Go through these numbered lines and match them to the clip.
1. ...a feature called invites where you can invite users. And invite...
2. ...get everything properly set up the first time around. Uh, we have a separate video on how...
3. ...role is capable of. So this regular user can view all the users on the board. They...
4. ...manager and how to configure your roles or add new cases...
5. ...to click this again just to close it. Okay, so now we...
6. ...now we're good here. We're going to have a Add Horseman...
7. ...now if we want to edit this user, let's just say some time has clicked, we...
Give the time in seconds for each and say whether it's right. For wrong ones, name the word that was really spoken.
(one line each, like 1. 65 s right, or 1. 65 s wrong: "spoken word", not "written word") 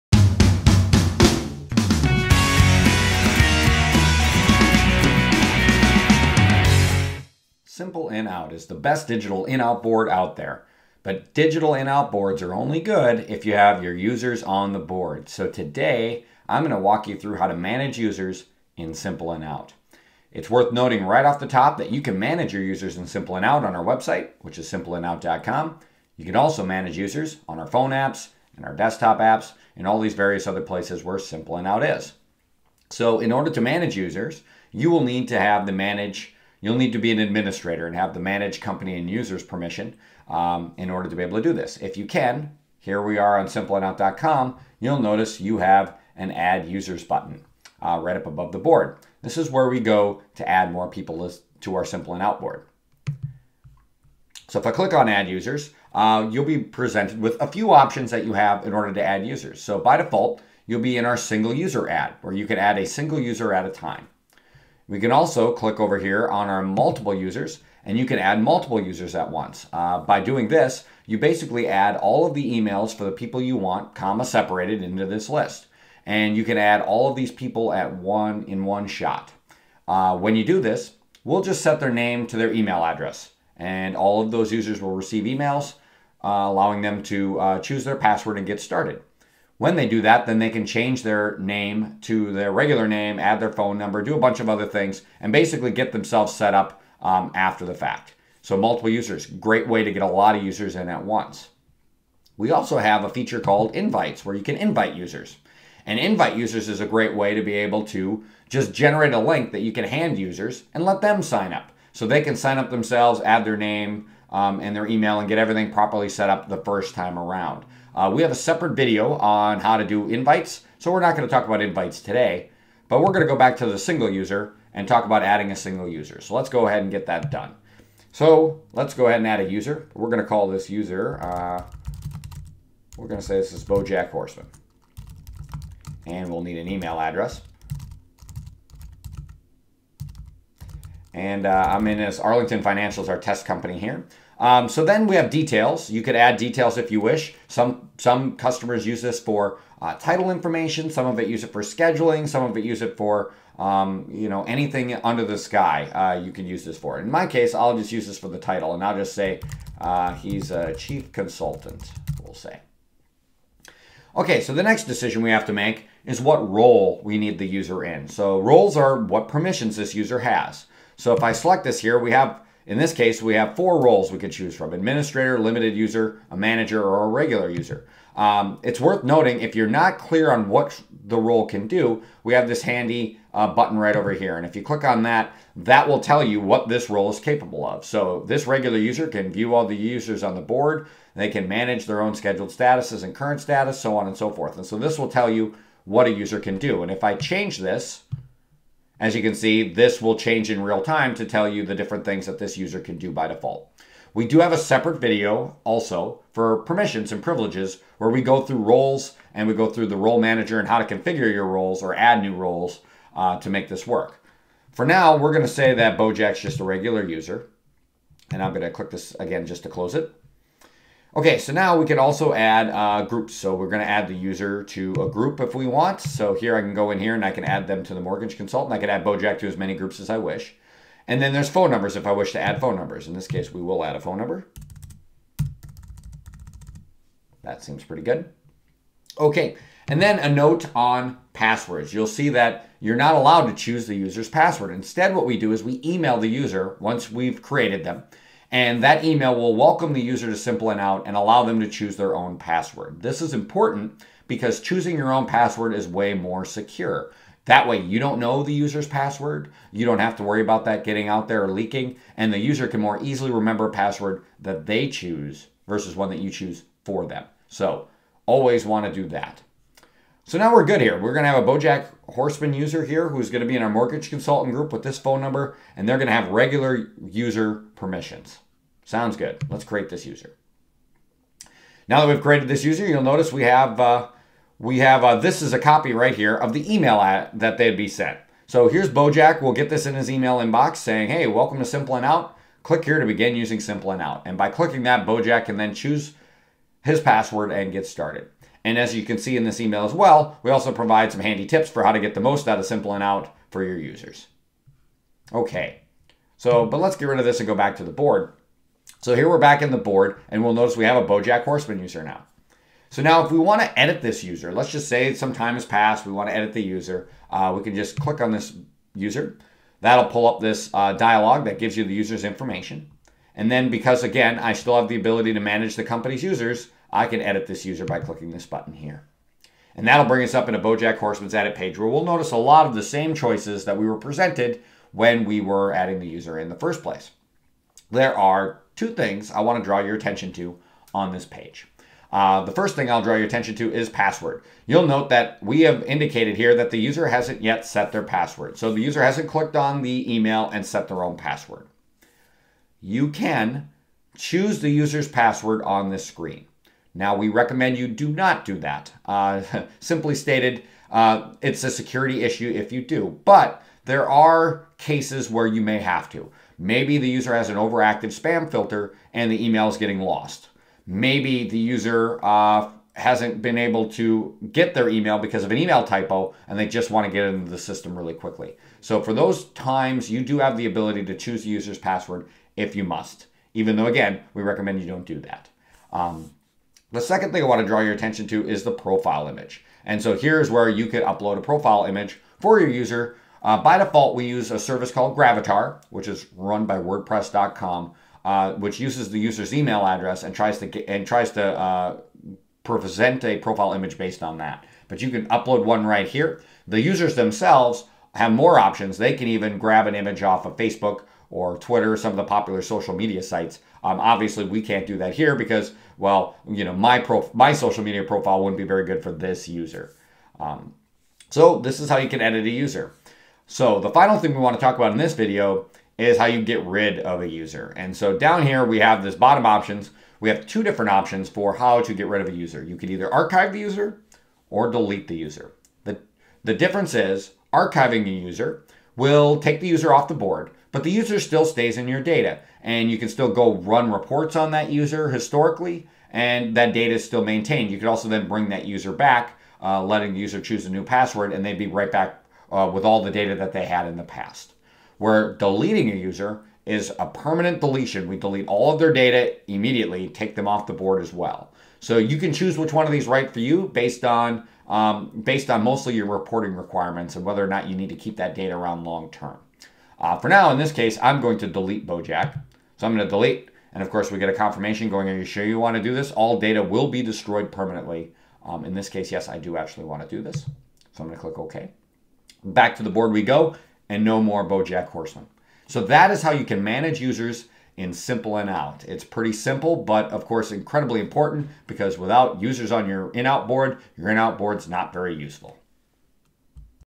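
1. 103 s right
2. 115 s right
3. 186 s right
4. 210 s wrong: "roles", not "cases"
5. 218 s right
6. 270 s wrong: "Bojack", not "Add"
7. 313 s wrong: "passed", not "clicked".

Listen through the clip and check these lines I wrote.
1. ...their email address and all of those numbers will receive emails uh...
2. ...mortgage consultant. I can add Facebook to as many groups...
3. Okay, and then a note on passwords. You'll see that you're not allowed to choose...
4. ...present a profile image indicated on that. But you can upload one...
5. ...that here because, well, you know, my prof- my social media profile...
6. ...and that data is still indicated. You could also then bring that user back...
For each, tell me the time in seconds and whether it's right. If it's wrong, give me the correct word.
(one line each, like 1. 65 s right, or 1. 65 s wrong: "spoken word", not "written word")
1. 82 s wrong: "users", not "numbers"
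2. 227 s wrong: "Bojack", not "Facebook"
3. 239 s right
4. 402 s wrong: "based", not "indicated"
5. 414 s right
6. 446 s wrong: "maintained", not "indicated".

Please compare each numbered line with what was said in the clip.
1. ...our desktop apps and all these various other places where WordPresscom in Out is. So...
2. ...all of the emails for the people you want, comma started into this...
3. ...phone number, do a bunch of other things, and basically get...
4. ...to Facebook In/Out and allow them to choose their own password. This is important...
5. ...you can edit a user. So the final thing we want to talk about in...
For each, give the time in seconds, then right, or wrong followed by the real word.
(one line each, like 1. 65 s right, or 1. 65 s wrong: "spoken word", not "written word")
1. 28 s wrong: "Simple", not "WordPresscom"
2. 71 s wrong: "separated", not "started"
3. 93 s right
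4. 250 s wrong: "Simple", not "Facebook"
5. 421 s right.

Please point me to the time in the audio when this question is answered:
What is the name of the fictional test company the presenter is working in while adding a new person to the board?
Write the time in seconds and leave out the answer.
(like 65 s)
142 s.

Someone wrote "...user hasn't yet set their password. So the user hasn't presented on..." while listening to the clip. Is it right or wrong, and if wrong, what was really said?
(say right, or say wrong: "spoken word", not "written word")
wrong: "clicked", not "presented".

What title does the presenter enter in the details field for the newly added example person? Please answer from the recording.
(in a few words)
Chief consultant.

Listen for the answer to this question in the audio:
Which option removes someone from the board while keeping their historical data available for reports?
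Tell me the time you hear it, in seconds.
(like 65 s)
433 s.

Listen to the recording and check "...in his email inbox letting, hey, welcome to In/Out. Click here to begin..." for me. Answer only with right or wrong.
wrong.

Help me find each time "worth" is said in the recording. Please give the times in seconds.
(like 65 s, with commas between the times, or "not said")
20 s, 178 s.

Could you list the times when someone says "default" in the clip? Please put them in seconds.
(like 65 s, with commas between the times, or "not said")
59 s, 203 s, 393 s.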